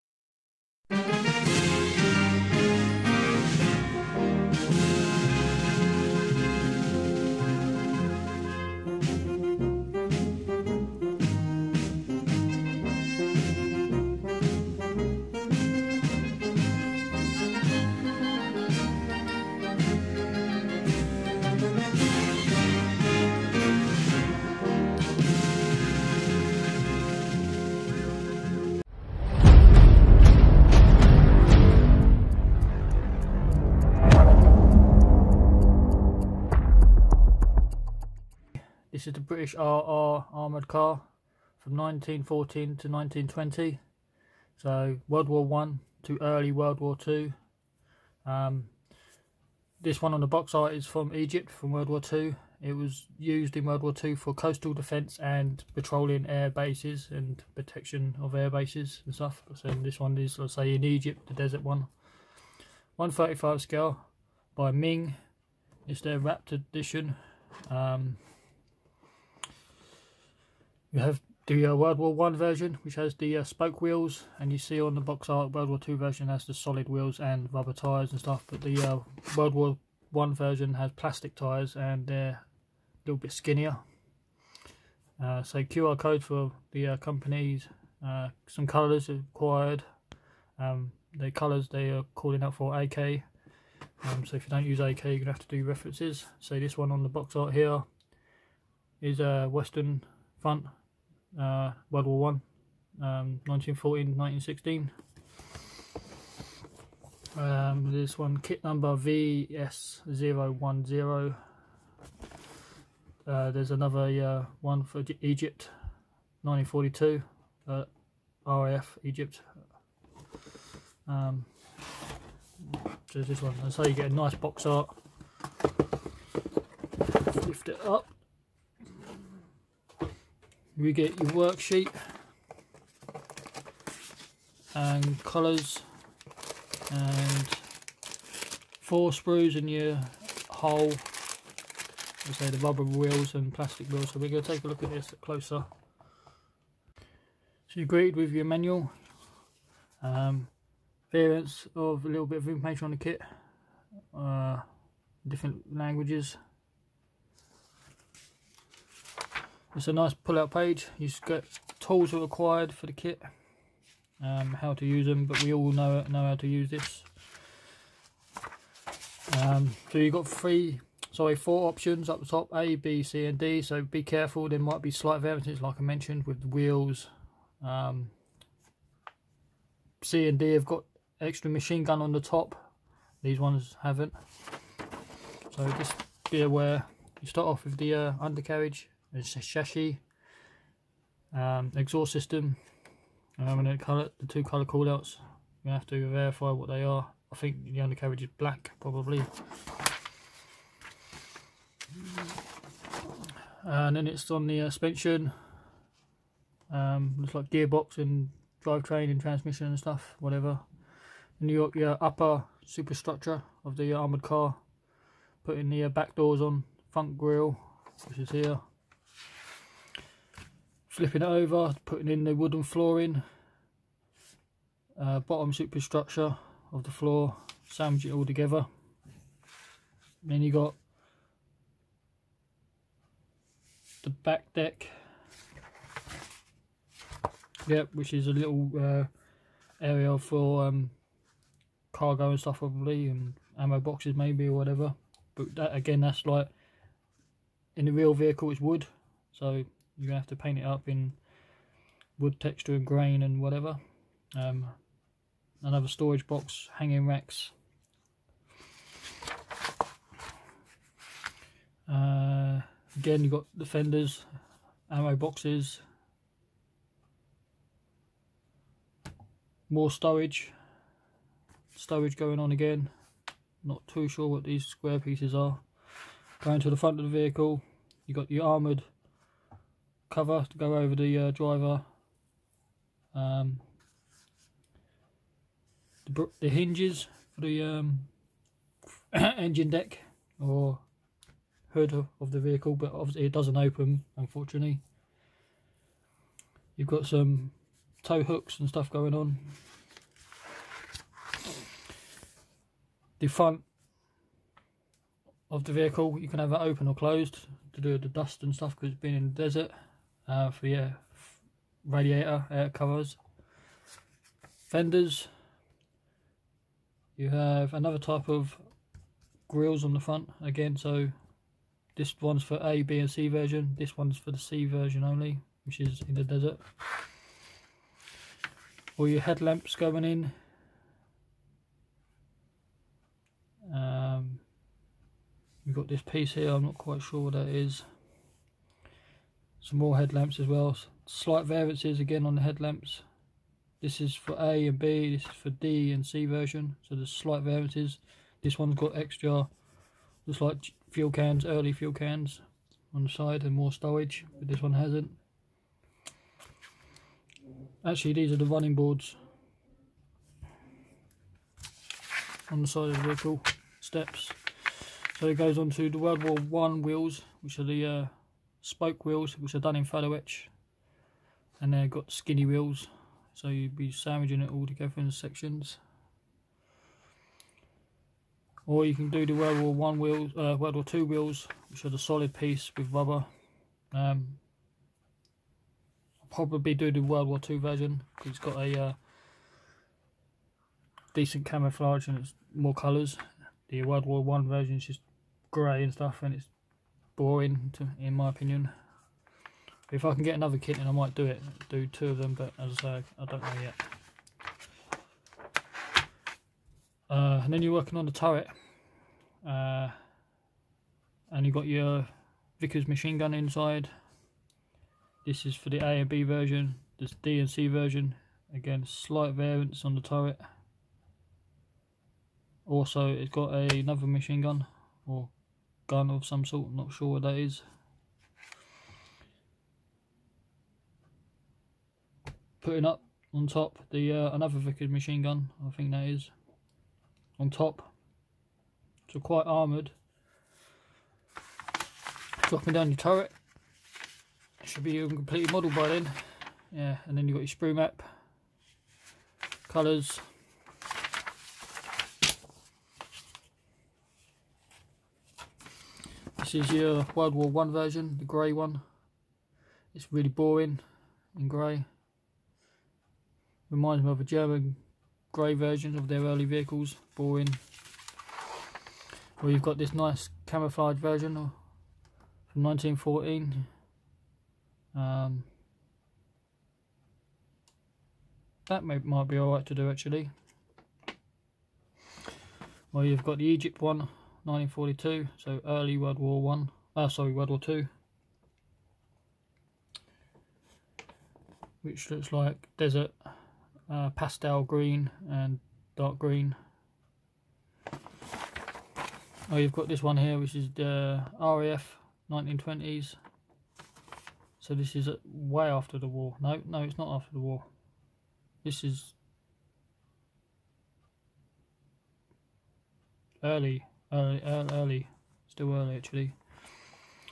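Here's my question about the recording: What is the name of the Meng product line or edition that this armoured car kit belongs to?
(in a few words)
Raptor edition.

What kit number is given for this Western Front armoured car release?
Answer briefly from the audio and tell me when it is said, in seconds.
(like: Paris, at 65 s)
VS010, at 108 s.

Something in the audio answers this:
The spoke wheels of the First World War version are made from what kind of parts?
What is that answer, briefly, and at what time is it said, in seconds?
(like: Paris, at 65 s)
photo-etch, at 369 s.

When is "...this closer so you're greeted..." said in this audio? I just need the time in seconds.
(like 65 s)
144 s.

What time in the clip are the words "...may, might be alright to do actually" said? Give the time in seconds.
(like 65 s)
478 s.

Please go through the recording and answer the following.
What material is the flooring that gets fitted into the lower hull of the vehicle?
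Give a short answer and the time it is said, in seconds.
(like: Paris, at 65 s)
wooden, at 222 s.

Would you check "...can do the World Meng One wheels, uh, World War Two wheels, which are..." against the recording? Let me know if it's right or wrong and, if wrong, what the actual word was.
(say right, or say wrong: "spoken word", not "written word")
wrong: "War", not "Meng".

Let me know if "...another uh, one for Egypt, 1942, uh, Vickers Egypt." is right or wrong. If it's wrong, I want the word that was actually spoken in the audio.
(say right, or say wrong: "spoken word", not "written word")
wrong: "RAF", not "Vickers".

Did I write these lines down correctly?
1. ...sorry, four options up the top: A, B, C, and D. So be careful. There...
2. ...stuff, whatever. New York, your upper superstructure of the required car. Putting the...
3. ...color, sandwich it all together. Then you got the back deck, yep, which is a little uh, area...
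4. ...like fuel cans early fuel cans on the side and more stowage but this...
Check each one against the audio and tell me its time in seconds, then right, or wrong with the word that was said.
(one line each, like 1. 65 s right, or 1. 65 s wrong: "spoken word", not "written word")
1. 171 s right
2. 209 s wrong: "armoured", not "required"
3. 226 s wrong: "floor", not "color"
4. 350 s right.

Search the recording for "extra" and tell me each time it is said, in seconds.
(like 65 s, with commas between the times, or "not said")
181 s, 348 s.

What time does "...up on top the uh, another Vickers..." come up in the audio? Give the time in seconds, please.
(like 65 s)
432 s.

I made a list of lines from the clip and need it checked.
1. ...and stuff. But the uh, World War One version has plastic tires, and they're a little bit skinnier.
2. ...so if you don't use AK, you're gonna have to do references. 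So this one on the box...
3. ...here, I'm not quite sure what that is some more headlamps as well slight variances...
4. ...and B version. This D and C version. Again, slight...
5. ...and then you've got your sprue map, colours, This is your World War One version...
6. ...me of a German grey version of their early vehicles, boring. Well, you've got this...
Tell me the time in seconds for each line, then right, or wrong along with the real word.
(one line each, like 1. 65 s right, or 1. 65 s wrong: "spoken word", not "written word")
1. 78 s right
2. 94 s right
3. 336 s right
4. 415 s right
5. 447 s right
6. 464 s right.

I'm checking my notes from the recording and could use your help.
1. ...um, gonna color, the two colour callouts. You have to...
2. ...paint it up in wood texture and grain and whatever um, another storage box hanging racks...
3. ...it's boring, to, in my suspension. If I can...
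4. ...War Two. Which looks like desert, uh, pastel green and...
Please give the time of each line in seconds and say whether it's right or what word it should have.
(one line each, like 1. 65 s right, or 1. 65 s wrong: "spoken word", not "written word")
1. 193 s right
2. 250 s right
3. 396 s wrong: "opinion", not "suspension"
4. 487 s right.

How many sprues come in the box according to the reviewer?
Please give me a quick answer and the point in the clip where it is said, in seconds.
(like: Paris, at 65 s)
4, at 138 s.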